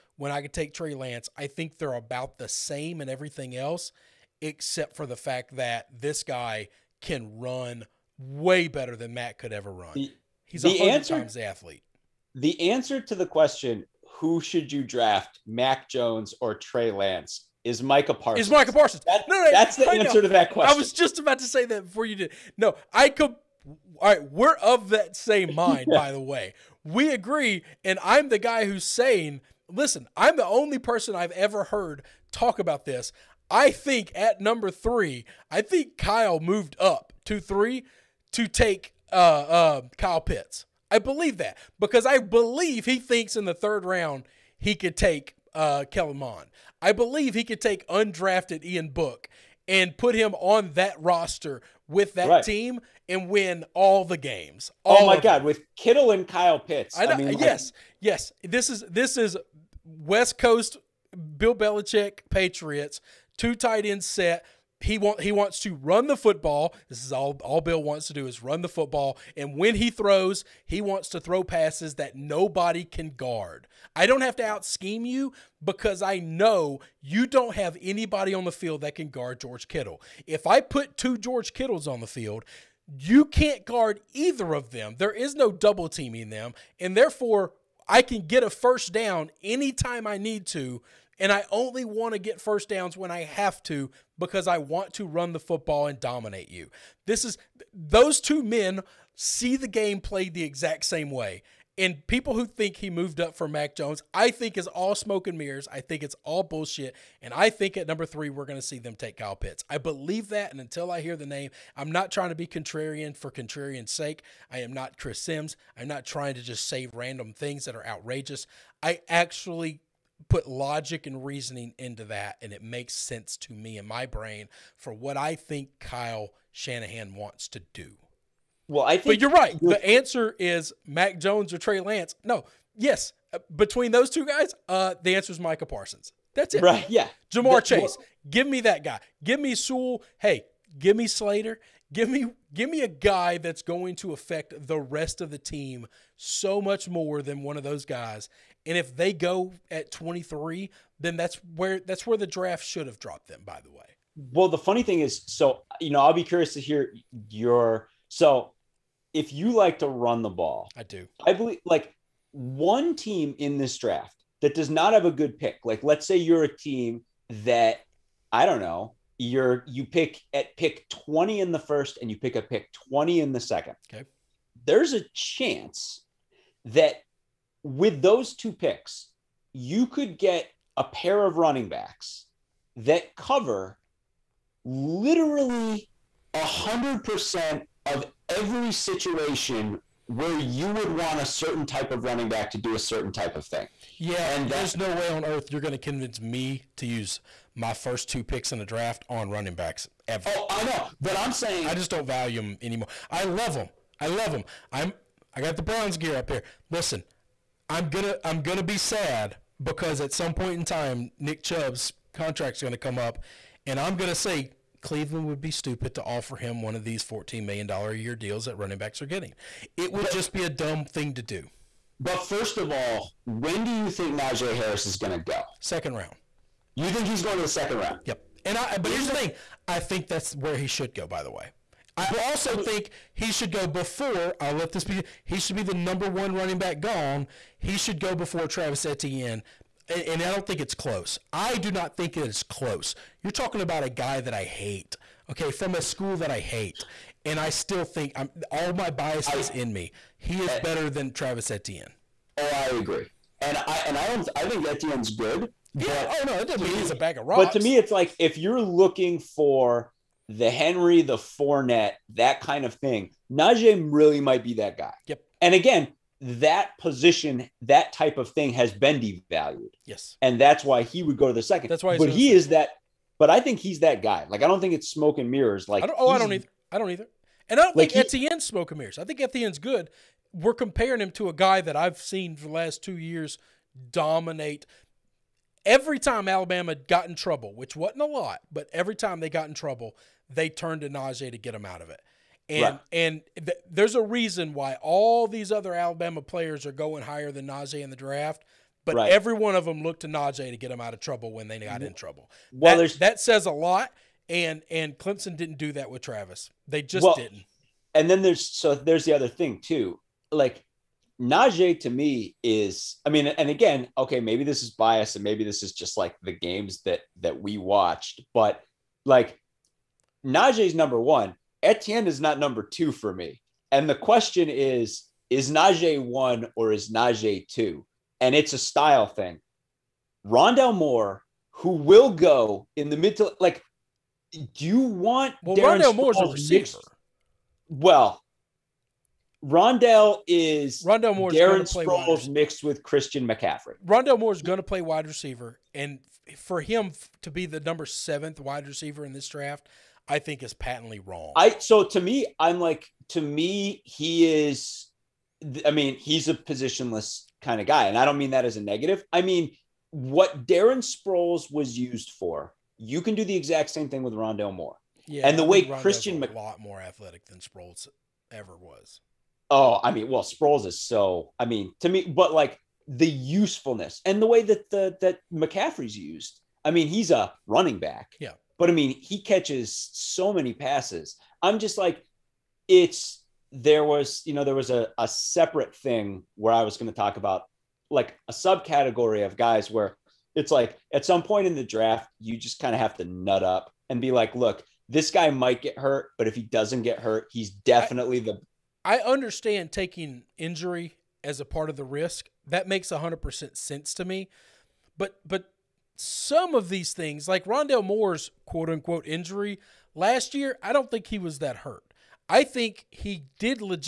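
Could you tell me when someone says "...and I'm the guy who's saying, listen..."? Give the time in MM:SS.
00:27.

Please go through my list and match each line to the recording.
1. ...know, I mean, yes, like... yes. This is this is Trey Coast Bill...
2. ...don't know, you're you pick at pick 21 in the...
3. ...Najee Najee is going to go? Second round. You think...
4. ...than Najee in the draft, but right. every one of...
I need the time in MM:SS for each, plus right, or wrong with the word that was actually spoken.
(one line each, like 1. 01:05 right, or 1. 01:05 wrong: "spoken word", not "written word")
1. 00:57 wrong: "West", not "Trey"
2. 02:48 wrong: "20", not "21"
3. 03:44 wrong: "Harris", not "Najee"
4. 04:57 right.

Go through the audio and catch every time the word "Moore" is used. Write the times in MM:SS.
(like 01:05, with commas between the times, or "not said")
05:30, 05:35, 05:41, 06:04, 06:47.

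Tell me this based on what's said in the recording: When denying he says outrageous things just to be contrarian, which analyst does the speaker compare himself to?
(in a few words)
Chris Sims.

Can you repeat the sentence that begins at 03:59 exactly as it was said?
And, and I don't think it's close.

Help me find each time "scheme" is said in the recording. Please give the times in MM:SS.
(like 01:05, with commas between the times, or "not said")
01:14.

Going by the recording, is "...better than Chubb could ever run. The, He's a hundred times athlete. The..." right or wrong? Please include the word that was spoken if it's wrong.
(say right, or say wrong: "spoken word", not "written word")
wrong: "Matt", not "Chubb".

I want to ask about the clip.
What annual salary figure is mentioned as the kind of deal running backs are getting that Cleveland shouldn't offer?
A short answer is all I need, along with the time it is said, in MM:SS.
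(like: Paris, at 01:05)
$14 million, at 03:37.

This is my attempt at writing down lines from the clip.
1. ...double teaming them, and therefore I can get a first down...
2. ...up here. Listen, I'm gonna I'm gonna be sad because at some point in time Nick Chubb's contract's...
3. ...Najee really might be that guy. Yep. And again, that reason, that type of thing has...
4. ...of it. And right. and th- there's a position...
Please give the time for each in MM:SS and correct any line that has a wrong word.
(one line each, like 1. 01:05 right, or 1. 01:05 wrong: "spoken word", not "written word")
1. 01:25 right
2. 03:26 right
3. 04:23 wrong: "position", not "reason"
4. 04:51 wrong: "reason", not "position".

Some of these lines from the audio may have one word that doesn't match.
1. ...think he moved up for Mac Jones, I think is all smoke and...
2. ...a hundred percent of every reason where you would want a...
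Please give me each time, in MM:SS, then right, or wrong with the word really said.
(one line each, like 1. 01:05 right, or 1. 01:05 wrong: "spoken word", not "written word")
1. 01:42 right
2. 03:06 wrong: "situation", not "reason".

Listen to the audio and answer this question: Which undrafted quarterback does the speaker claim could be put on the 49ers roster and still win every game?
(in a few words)
Ian Book.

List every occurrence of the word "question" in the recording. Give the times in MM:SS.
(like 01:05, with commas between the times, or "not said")
00:13, 00:20, 05:23.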